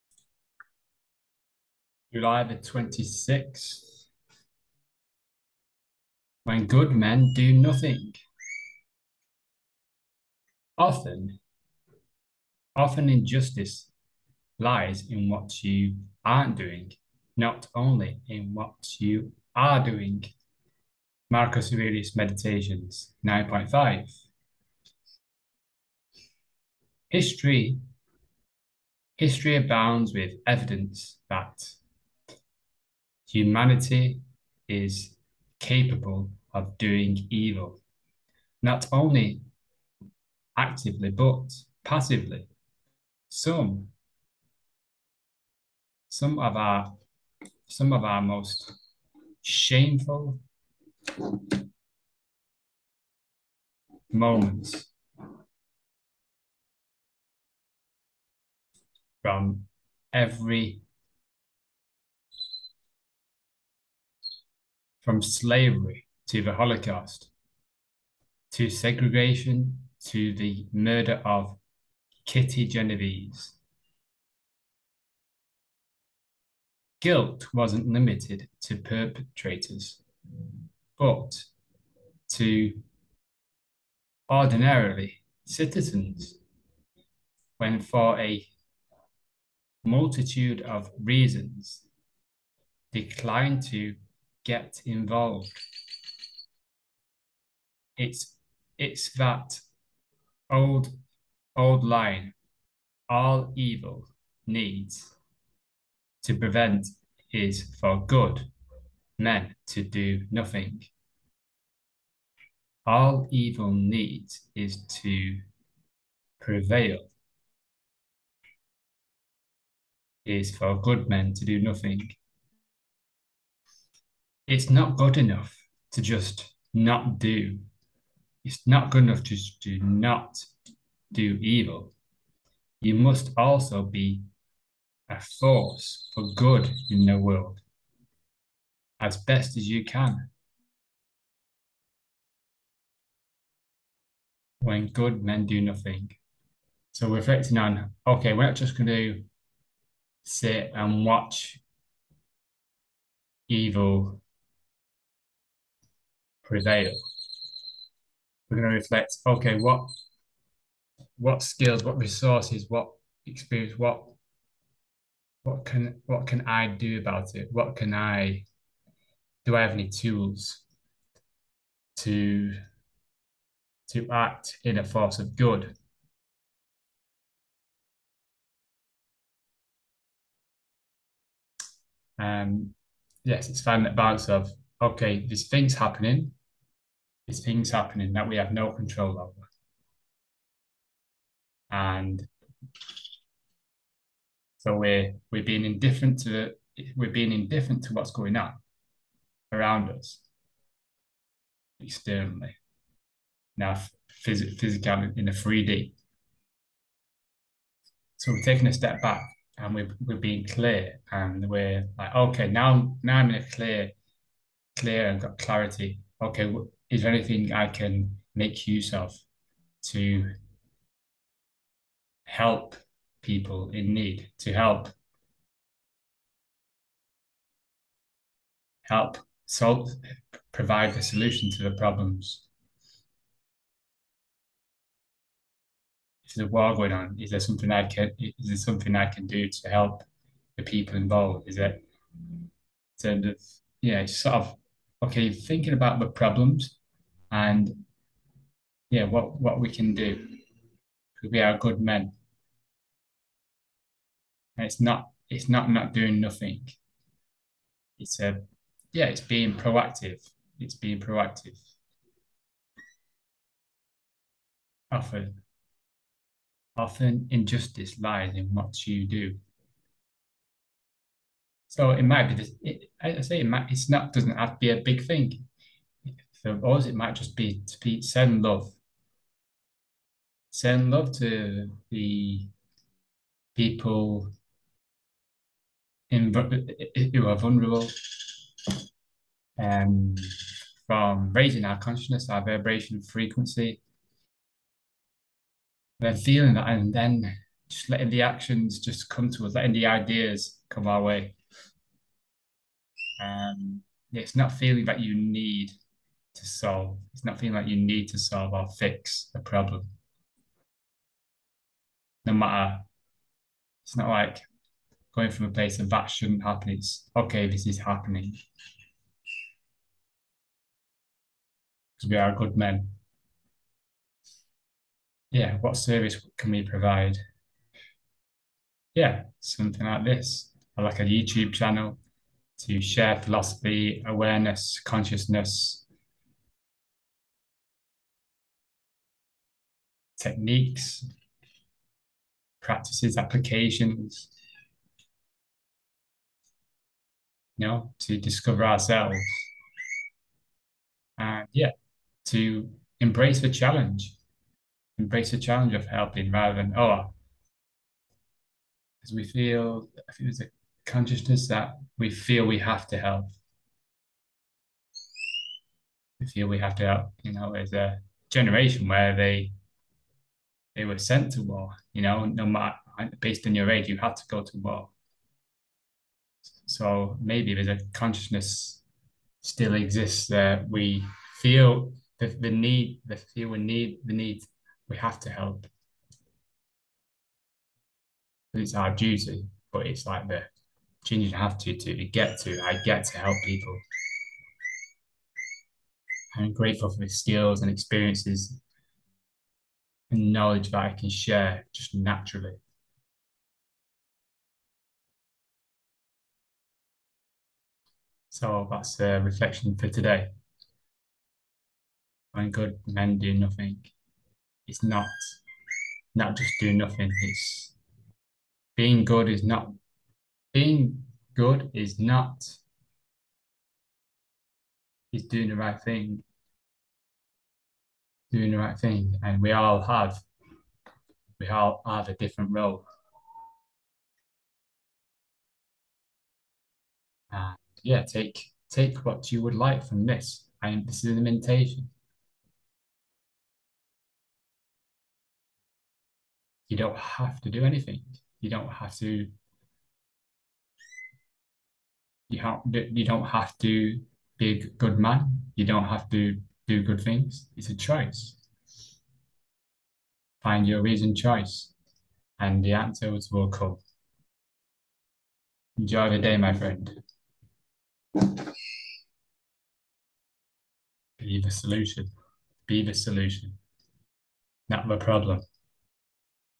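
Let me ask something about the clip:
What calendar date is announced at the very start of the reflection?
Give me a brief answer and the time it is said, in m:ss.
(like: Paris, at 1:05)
July 26th, at 0:02.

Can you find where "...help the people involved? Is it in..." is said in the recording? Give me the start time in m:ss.
3:59.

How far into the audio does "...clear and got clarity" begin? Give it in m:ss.
3:34.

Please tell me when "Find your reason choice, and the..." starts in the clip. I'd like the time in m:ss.
7:40.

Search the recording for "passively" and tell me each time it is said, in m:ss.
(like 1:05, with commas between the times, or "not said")
0:41.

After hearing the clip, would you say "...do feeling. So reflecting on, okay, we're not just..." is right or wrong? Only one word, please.
wrong.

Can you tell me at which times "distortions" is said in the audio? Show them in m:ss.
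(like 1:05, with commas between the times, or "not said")
not said.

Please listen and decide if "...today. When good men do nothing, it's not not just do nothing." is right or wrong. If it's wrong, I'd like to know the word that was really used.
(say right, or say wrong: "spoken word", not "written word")
right.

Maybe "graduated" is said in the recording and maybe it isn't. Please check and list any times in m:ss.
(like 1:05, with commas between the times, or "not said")
not said.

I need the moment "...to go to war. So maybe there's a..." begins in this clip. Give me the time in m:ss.
6:14.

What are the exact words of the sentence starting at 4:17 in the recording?
It's a uh, yeah, it's being proactive.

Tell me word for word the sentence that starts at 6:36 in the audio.
I'm grateful for the skills and experiences and knowledge that I can share just naturally.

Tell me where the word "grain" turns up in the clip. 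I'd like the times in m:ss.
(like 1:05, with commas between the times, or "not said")
not said.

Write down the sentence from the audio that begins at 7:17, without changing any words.
And yeah, take take what you would like from this.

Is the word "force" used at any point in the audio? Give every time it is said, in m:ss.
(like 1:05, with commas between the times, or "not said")
2:15, 2:54.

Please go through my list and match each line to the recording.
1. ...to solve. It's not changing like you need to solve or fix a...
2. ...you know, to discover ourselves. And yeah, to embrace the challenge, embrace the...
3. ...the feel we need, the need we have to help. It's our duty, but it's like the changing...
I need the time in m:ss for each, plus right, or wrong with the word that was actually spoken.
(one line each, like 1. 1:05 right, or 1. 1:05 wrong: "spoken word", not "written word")
1. 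5:06 wrong: "feeling", not "changing"
2. 5:47 right
3. 6:23 right.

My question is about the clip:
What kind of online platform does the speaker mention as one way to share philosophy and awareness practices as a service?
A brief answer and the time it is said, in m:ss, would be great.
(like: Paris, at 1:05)
YouTube channel, at 5:31.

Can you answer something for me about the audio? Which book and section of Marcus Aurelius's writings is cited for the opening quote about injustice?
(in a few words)
Meditations 9.5.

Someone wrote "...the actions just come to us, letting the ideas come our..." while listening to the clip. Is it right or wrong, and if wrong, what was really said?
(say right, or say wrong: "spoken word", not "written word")
right.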